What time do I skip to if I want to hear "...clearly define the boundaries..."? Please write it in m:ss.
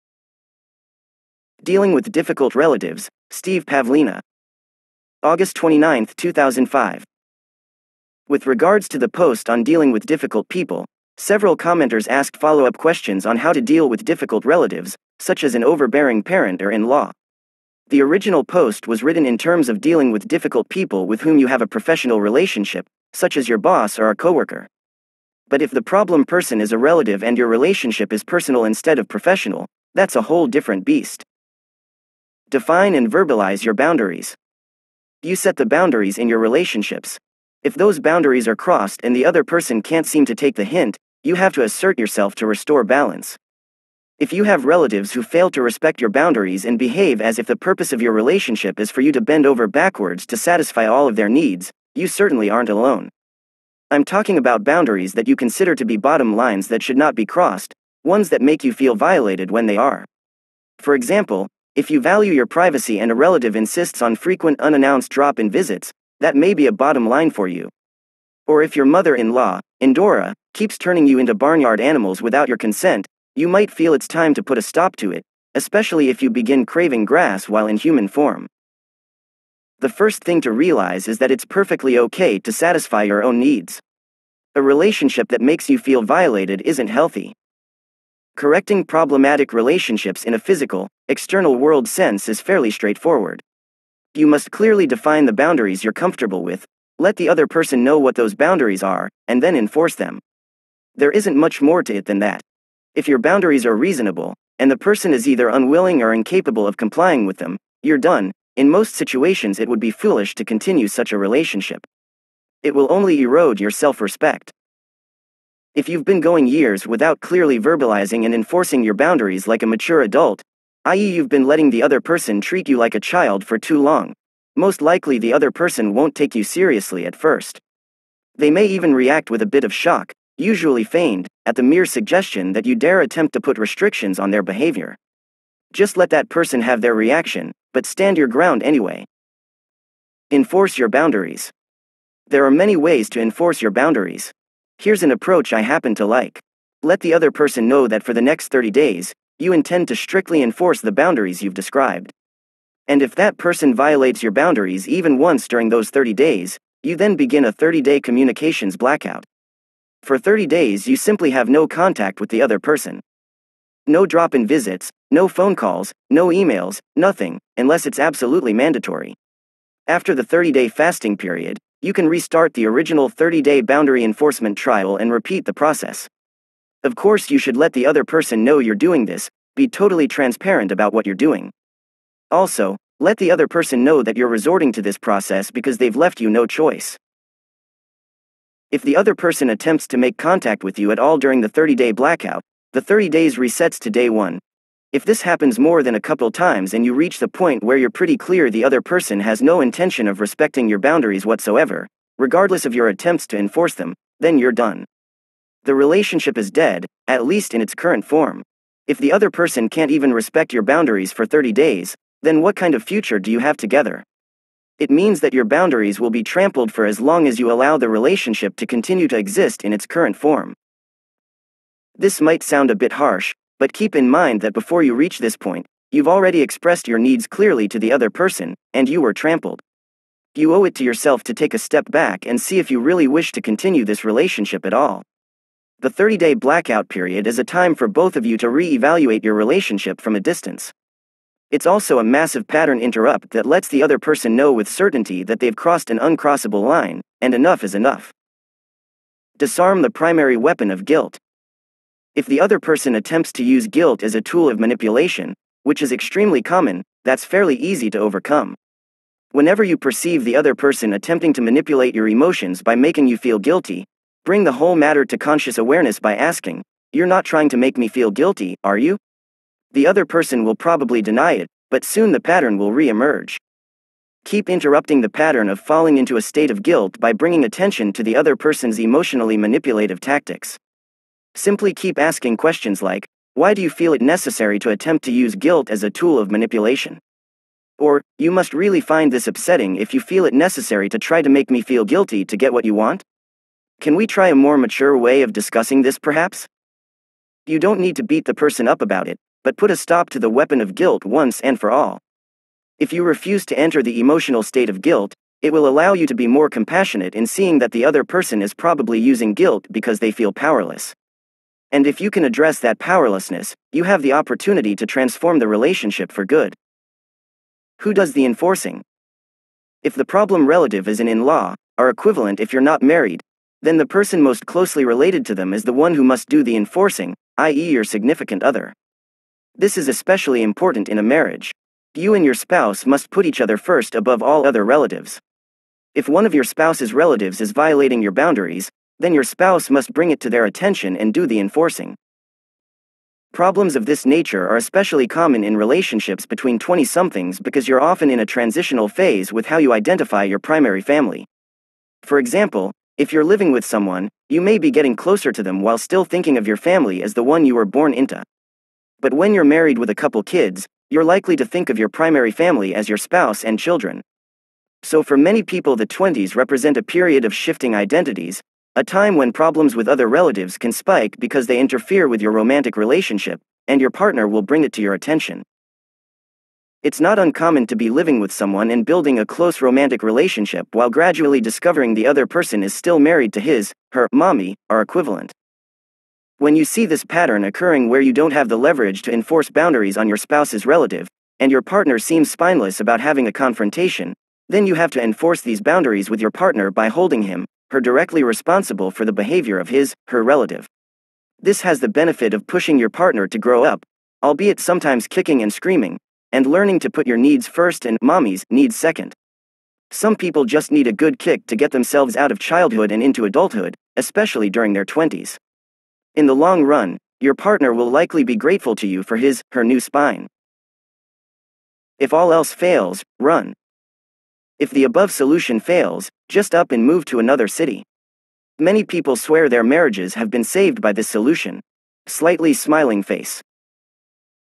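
1:34.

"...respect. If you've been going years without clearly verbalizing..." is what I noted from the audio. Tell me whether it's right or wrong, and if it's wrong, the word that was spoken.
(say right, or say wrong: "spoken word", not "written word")
right.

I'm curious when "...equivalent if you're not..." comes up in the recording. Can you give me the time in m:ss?
5:21.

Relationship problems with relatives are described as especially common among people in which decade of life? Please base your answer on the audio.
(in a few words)
20s.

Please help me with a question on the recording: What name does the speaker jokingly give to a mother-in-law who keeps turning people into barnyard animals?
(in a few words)
Endora.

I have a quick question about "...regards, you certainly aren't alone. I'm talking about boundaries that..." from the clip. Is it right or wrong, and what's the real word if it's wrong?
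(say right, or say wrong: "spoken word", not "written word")
wrong: "needs", not "regards".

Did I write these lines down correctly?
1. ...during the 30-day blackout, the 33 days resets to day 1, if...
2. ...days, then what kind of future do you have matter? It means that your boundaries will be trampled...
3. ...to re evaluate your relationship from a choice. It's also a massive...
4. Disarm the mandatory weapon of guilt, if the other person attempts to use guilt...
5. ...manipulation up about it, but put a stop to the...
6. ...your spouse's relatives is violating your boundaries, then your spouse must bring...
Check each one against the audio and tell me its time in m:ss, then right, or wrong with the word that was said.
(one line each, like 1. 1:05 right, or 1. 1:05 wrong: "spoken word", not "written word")
1. 3:11 wrong: "30", not "33"
2. 3:31 wrong: "together", not "matter"
3. 3:58 wrong: "distance", not "choice"
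4. 4:09 wrong: "primary", not "mandatory"
5. 4:58 wrong: "person", not "manipulation"
6. 5:36 right.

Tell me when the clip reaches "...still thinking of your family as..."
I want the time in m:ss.
5:55.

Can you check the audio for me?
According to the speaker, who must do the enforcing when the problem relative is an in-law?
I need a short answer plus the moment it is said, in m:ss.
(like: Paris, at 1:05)
your significant other, at 5:27.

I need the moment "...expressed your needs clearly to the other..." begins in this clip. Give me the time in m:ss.
3:46.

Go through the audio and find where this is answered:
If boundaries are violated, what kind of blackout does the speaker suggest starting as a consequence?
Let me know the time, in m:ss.
2:38.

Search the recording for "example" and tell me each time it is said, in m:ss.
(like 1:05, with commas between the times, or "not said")
1:00, 5:52.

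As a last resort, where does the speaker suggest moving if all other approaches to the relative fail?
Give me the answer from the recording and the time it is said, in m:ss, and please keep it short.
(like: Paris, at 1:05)
another city, at 7:07.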